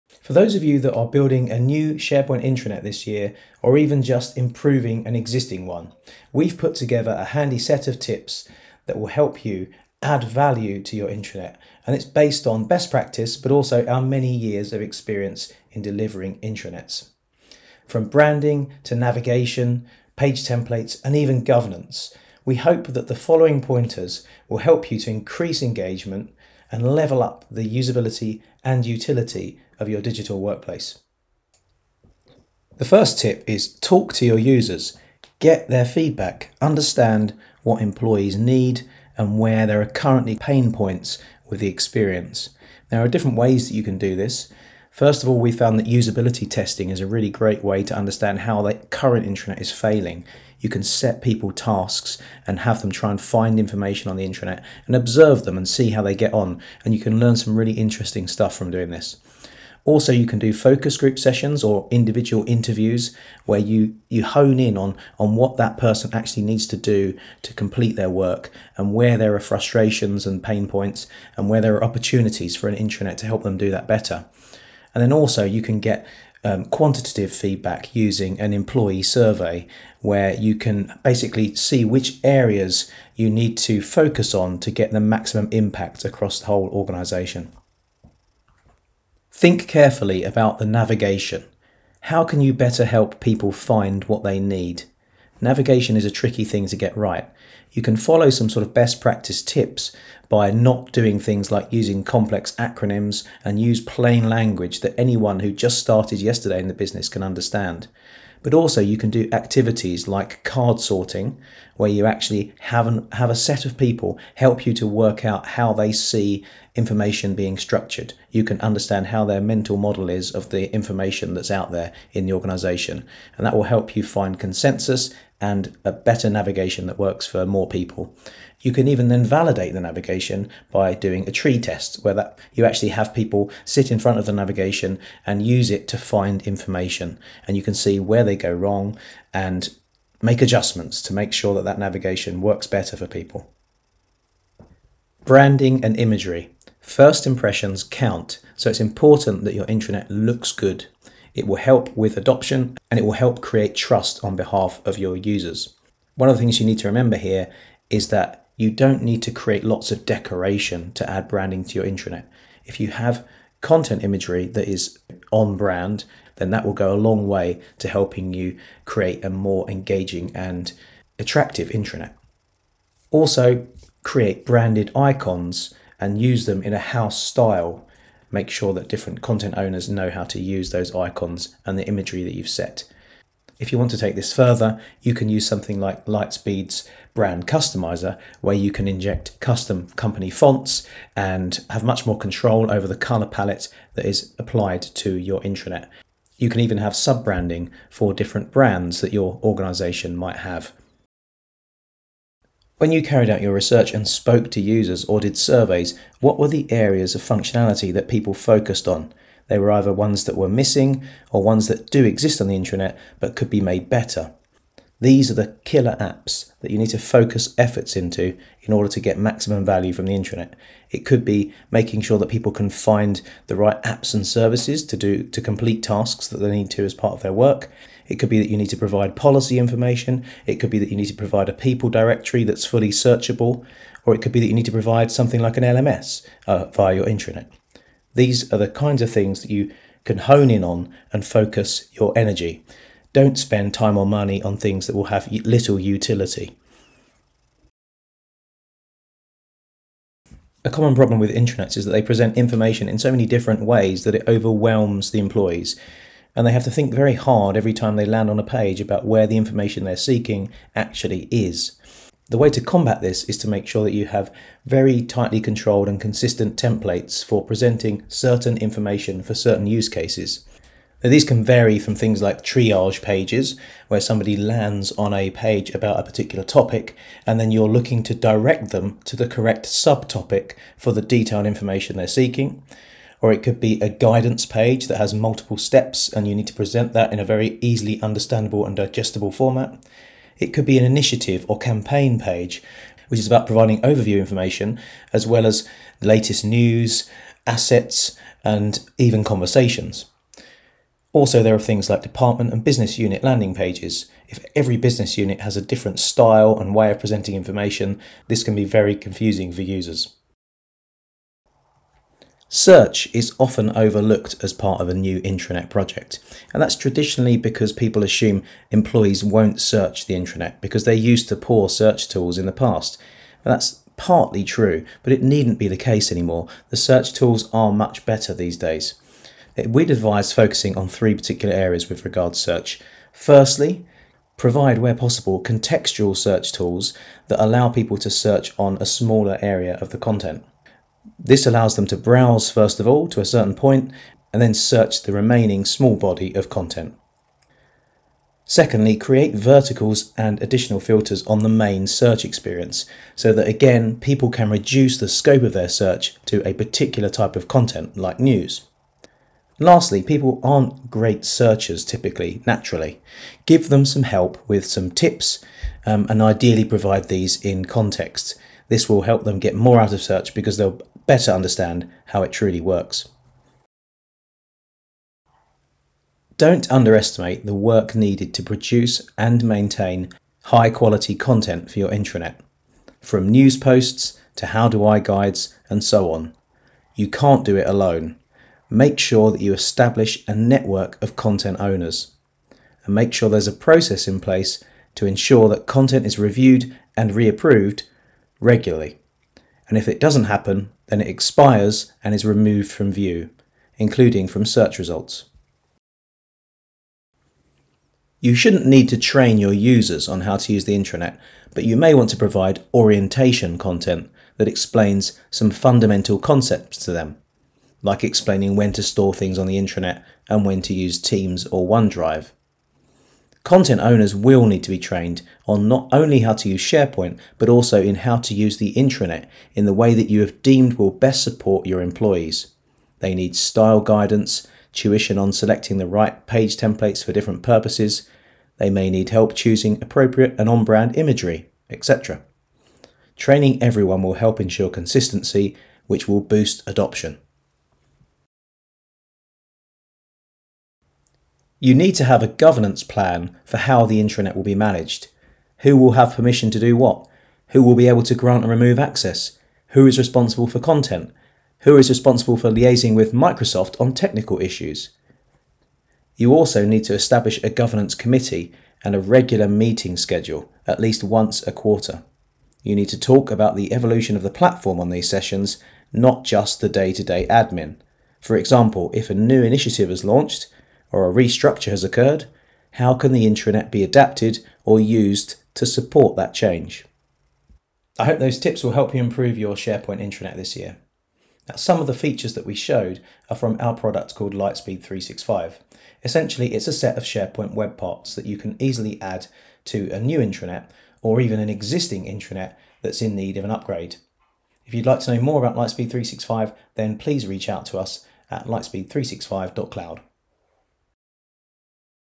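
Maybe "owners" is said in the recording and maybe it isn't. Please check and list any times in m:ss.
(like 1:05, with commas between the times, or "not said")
2:59, 6:31, 7:03.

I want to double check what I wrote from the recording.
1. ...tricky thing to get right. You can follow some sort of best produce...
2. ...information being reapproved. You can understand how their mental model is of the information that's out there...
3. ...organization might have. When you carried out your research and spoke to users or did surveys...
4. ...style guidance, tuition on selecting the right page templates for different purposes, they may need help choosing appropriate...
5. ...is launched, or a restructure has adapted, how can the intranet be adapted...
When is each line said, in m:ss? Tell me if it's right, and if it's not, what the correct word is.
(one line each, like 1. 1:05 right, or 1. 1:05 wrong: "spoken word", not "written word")
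1. 1:36 wrong: "practice", not "produce"
2. 1:56 wrong: "structured", not "reapproved"
3. 3:19 right
4. 7:13 right
5. 7:59 wrong: "occurred", not "adapted".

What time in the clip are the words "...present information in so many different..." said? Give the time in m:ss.
4:12.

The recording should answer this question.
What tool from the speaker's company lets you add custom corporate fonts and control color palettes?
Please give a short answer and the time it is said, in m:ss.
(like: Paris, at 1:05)
Brand customizer, at 3:07.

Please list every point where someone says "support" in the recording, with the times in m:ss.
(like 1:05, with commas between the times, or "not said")
7:11, 8:05.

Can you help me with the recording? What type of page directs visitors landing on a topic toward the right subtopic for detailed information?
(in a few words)
Triage pages.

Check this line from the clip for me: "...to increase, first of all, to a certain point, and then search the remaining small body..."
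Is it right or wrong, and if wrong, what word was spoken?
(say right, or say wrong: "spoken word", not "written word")
wrong: "browse", not "increase".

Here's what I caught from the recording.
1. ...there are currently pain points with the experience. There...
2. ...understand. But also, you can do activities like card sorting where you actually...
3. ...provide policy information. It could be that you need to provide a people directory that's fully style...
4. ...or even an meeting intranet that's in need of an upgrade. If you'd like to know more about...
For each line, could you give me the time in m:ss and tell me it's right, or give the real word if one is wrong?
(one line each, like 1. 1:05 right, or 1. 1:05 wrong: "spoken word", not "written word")
1. 0:39 right
2. 1:47 right
3. 3:48 wrong: "searchable", not "style"
4. 8:21 wrong: "existing", not "meeting".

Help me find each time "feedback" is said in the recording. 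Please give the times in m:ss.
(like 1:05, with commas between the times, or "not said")
0:35, 1:17.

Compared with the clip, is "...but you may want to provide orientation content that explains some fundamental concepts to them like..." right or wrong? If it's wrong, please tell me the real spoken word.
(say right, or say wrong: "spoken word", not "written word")
right.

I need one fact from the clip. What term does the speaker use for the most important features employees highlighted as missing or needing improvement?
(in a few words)
Killer apps.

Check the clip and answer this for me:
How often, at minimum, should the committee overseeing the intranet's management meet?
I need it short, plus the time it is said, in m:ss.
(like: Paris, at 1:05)
Once a quarter, at 7:51.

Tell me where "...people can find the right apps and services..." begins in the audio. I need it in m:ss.
3:42.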